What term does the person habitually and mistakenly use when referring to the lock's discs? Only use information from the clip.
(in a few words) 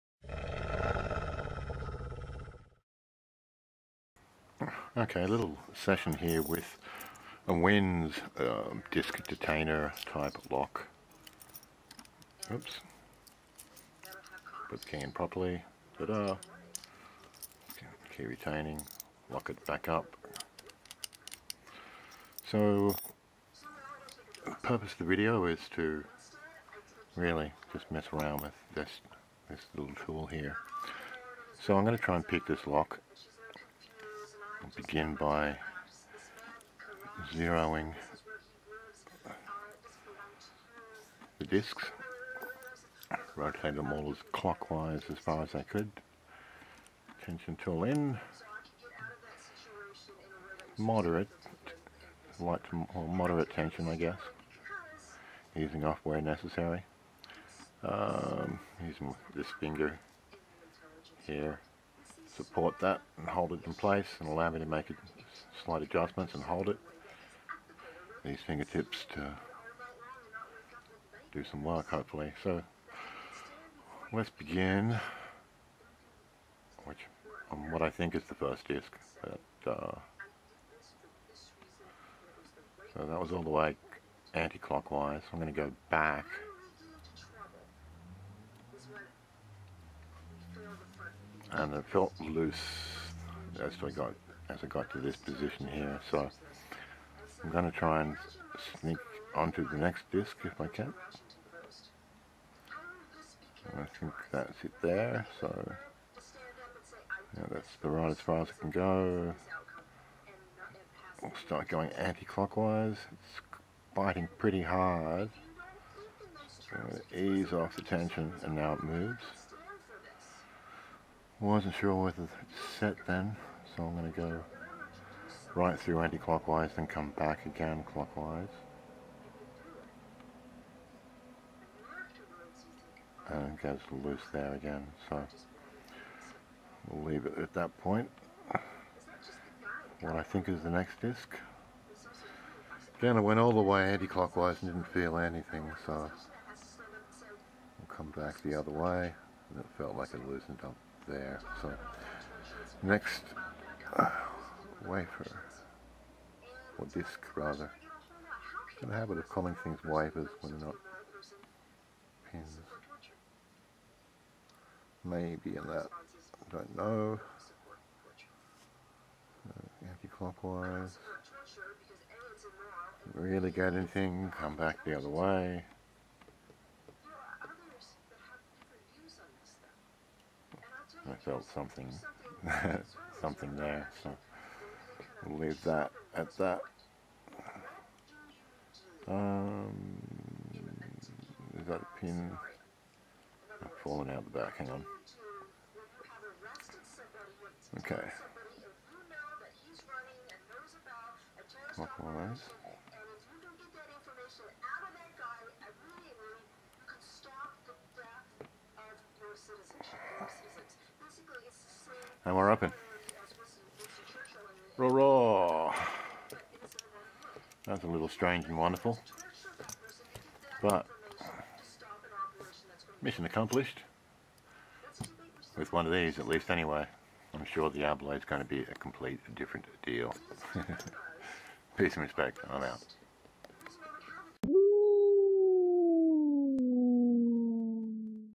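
wafers.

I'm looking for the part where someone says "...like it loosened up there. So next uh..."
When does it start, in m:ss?
2:29.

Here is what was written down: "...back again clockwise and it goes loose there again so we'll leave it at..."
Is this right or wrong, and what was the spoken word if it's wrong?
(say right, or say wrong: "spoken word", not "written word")
right.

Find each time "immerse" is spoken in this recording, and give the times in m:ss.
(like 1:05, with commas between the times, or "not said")
not said.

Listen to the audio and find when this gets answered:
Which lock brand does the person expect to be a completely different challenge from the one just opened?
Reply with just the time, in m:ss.
3:47.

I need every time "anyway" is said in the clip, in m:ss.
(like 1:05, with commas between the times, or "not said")
3:46.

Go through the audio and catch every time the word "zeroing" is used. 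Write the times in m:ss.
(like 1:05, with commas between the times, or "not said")
0:37.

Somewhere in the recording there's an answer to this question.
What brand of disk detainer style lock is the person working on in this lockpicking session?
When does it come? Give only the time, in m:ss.
0:07.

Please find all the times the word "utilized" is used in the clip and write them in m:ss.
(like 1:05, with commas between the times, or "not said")
not said.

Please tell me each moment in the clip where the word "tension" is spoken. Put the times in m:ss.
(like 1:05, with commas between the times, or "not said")
0:47, 0:53, 1:57.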